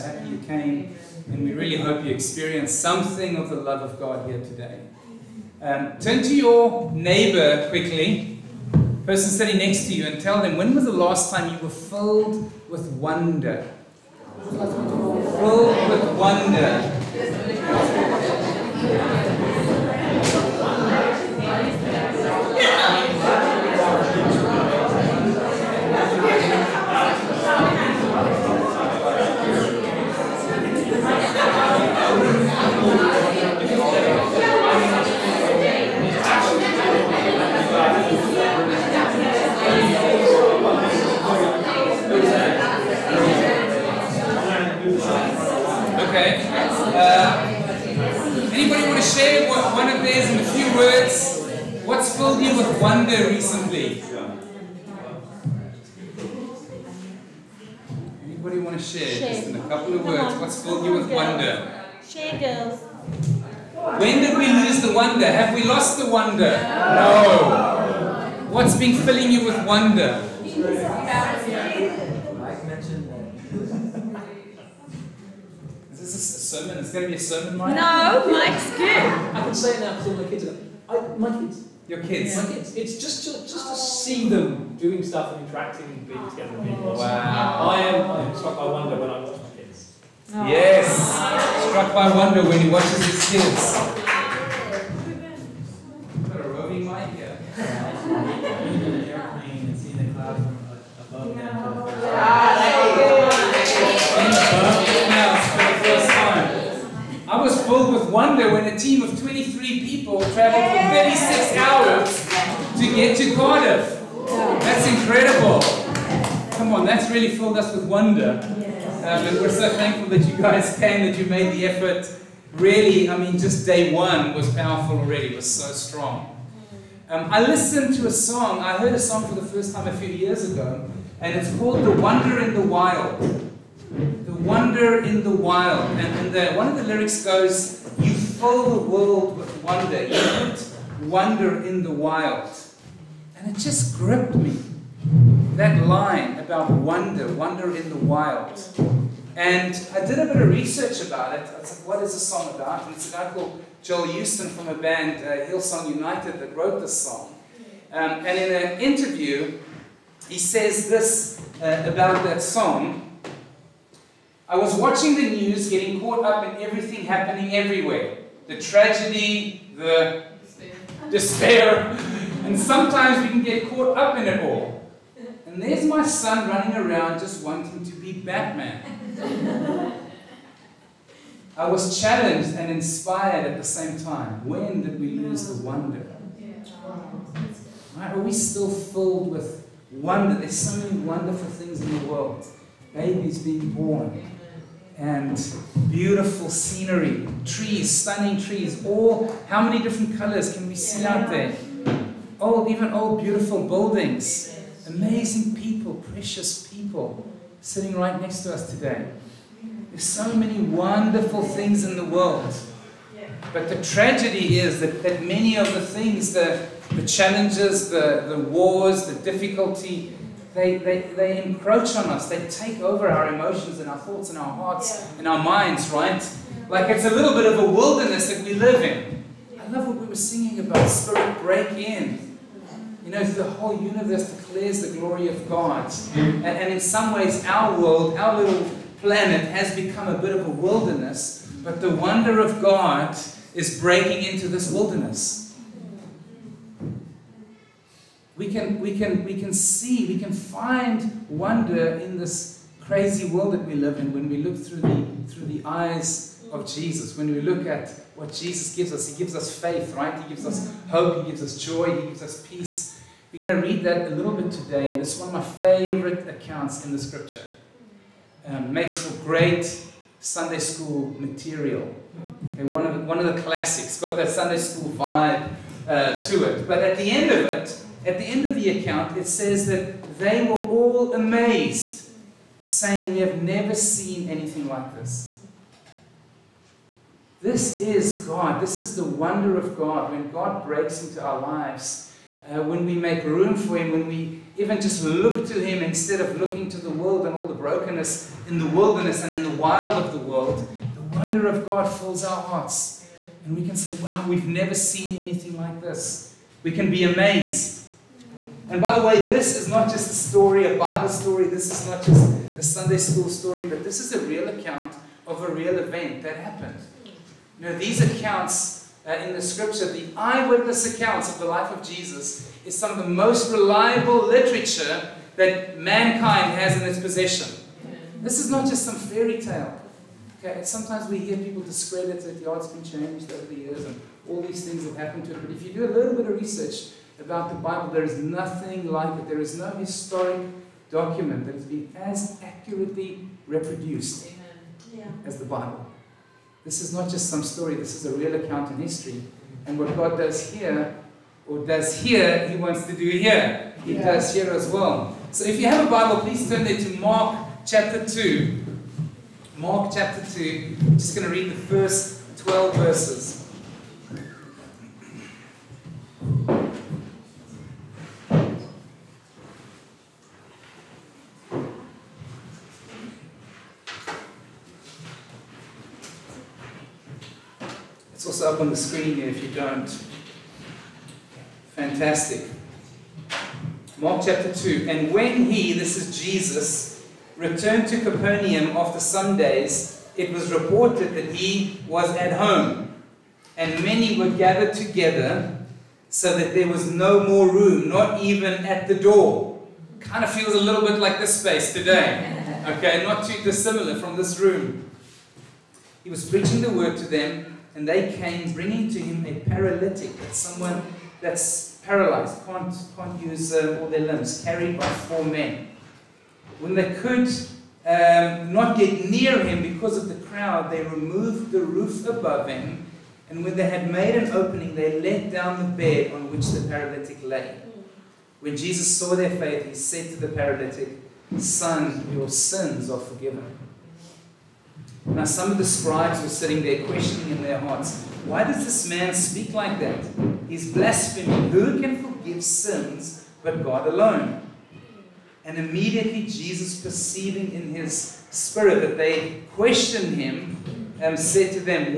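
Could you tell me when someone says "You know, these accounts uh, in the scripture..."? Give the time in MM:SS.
05:17.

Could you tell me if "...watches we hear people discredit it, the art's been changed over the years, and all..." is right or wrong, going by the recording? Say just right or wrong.
wrong.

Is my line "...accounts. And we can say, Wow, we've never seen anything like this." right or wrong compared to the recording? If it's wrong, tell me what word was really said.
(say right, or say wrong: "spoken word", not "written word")
wrong: "hearts", not "accounts".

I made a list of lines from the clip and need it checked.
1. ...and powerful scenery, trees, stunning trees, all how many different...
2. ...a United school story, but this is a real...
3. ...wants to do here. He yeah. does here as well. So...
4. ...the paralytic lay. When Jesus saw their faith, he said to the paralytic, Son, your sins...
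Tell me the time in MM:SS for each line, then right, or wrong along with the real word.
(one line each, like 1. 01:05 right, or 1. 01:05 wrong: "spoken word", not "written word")
1. 03:14 wrong: "beautiful", not "powerful"
2. 05:12 wrong: "Sunday", not "United"
3. 05:52 right
4. 07:06 right.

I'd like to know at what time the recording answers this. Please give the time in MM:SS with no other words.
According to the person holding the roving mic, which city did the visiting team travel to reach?
01:53.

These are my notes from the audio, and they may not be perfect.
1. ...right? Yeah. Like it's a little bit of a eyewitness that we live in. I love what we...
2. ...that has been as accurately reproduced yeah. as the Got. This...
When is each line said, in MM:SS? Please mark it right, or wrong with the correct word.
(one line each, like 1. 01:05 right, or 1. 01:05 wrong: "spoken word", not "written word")
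1. 03:45 wrong: "wilderness", not "eyewitness"
2. 05:41 wrong: "Bible", not "Got".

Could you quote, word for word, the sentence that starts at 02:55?
And there's my son running around just wanting to be Batman.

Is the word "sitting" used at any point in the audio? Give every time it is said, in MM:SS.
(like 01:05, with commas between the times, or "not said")
00:09, 03:27, 07:16.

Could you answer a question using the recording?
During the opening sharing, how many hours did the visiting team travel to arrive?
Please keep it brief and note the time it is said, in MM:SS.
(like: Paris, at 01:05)
36 hours, at 01:50.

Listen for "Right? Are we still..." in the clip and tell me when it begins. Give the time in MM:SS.
03:07.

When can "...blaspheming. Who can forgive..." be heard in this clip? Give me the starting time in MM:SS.
07:20.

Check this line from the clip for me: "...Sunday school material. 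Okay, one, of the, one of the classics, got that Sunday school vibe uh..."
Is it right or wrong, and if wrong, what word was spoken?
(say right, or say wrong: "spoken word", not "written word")
right.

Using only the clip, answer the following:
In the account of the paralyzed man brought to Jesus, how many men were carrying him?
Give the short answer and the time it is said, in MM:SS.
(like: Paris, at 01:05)
4, at 06:54.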